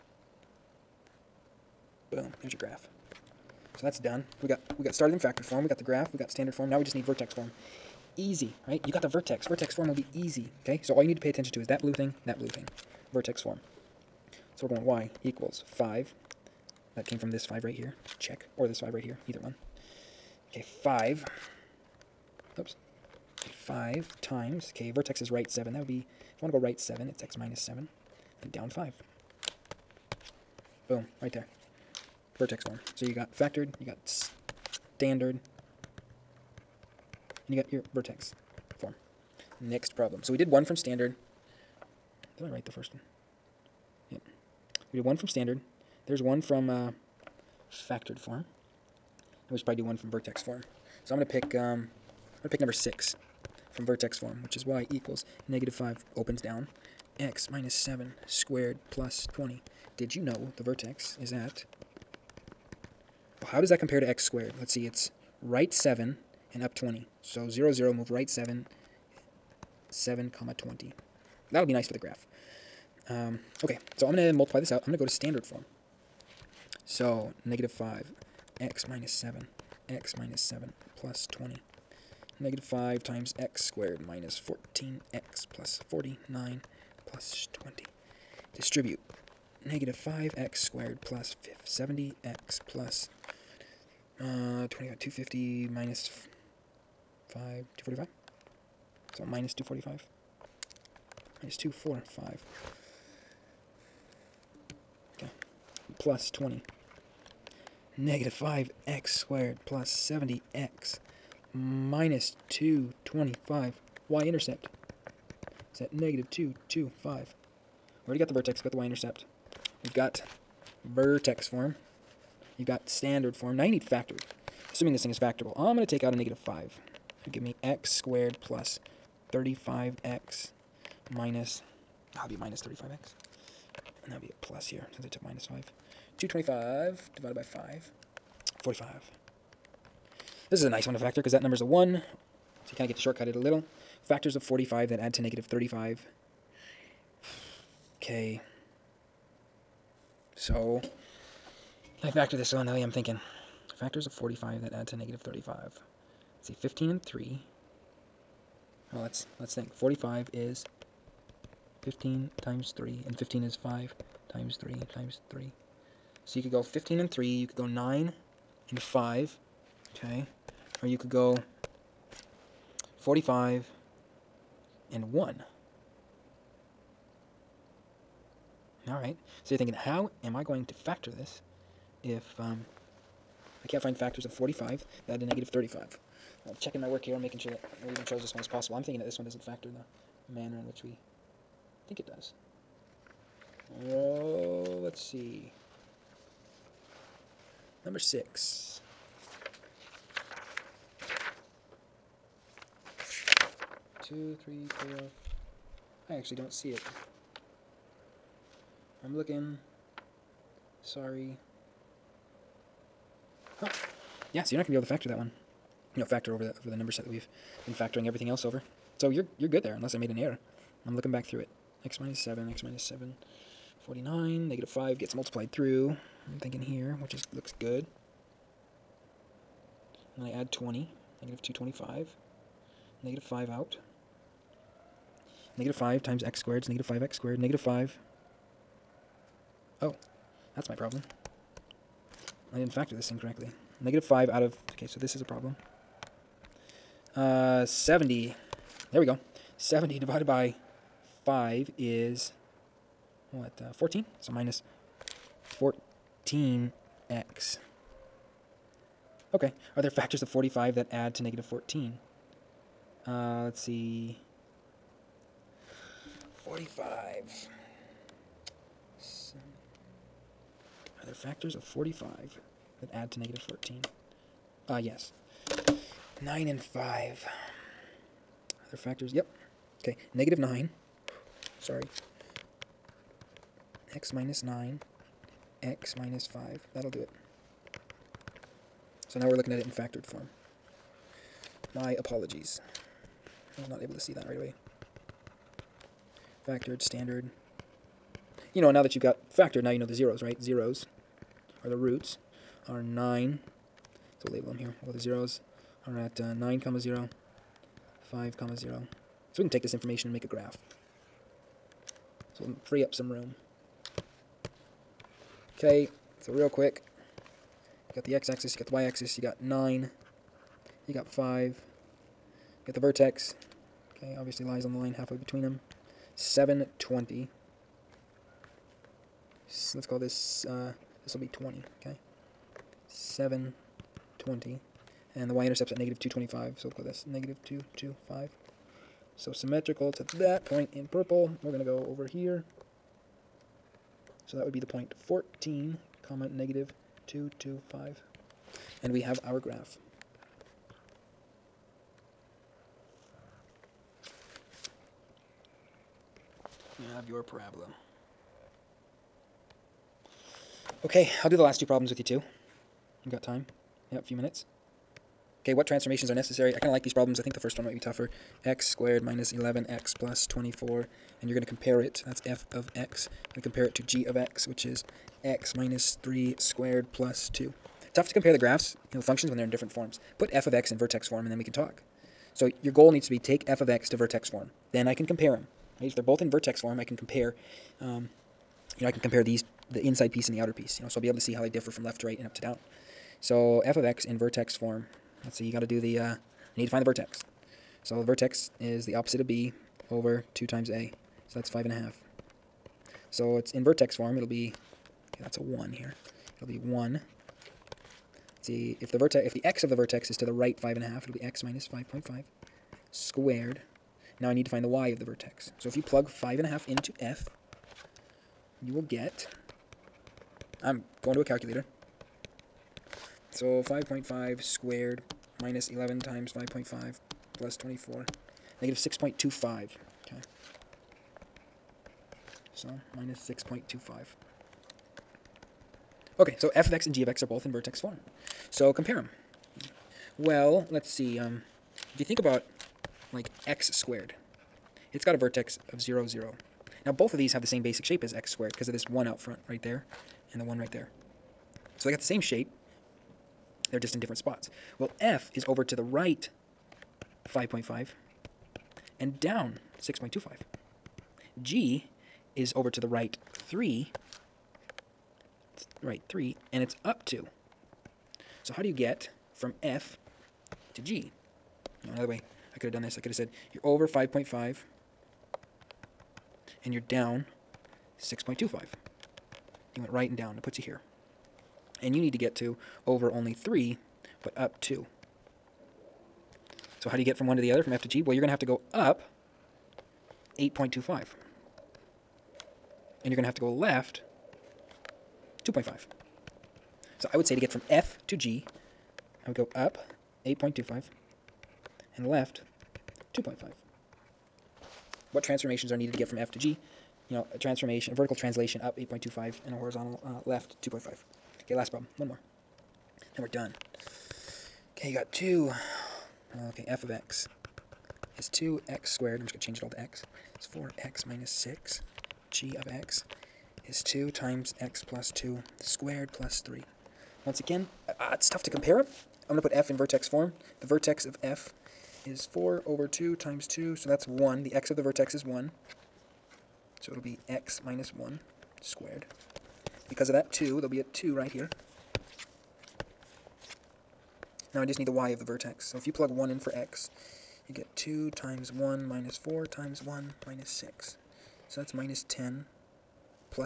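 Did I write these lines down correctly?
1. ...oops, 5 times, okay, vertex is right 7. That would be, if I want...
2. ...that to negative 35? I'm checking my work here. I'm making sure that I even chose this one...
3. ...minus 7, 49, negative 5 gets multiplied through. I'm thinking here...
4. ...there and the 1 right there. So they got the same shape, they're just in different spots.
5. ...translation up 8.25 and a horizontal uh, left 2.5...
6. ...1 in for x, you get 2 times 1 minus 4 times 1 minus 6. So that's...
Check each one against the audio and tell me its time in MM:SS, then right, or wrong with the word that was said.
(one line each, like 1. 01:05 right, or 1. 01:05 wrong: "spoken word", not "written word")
1. 00:22 right
2. 03:05 right
3. 03:42 right
4. 07:29 right
5. 08:28 right
6. 09:06 right.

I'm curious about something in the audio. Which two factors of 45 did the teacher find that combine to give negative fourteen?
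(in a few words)
9 and 5.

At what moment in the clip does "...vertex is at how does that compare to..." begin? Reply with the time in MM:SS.
01:00.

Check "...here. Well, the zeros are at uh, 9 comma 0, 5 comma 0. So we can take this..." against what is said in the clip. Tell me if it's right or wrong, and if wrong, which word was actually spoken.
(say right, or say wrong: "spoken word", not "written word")
right.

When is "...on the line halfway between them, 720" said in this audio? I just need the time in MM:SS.
05:24.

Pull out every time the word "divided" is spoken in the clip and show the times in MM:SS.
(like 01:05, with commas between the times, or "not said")
02:17, 04:09.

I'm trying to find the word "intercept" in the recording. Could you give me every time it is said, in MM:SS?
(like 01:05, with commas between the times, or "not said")
01:54, 01:58, 05:35.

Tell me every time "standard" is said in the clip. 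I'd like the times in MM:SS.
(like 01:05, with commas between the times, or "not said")
00:06, 00:34, 00:40, 00:45, 01:15, 02:02, 04:56.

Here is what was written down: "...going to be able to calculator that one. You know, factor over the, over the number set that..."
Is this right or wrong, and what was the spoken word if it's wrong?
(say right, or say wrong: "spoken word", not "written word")
wrong: "factor", not "calculator".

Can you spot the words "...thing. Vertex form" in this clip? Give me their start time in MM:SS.
00:12.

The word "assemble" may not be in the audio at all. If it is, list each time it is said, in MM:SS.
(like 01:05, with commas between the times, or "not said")
not said.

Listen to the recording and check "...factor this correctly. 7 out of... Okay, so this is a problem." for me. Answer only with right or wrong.
wrong.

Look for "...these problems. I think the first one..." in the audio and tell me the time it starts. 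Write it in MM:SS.
06:06.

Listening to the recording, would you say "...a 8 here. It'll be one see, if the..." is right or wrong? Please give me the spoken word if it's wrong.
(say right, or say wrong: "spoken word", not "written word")
wrong: "1", not "8".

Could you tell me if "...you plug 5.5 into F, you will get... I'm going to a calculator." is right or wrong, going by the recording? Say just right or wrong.
right.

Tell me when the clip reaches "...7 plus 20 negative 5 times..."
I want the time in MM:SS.
01:20.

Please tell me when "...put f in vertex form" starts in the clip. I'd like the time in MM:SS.
08:49.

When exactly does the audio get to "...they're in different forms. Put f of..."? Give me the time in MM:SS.
06:19.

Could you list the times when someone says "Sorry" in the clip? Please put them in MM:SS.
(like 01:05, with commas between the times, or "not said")
03:30, 04:41.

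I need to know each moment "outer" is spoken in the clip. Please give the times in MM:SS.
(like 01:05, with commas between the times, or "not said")
06:30.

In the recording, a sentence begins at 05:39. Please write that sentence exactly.
So symmetrical to that point in purple, we're going to go over here.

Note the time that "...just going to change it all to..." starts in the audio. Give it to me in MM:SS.
08:39.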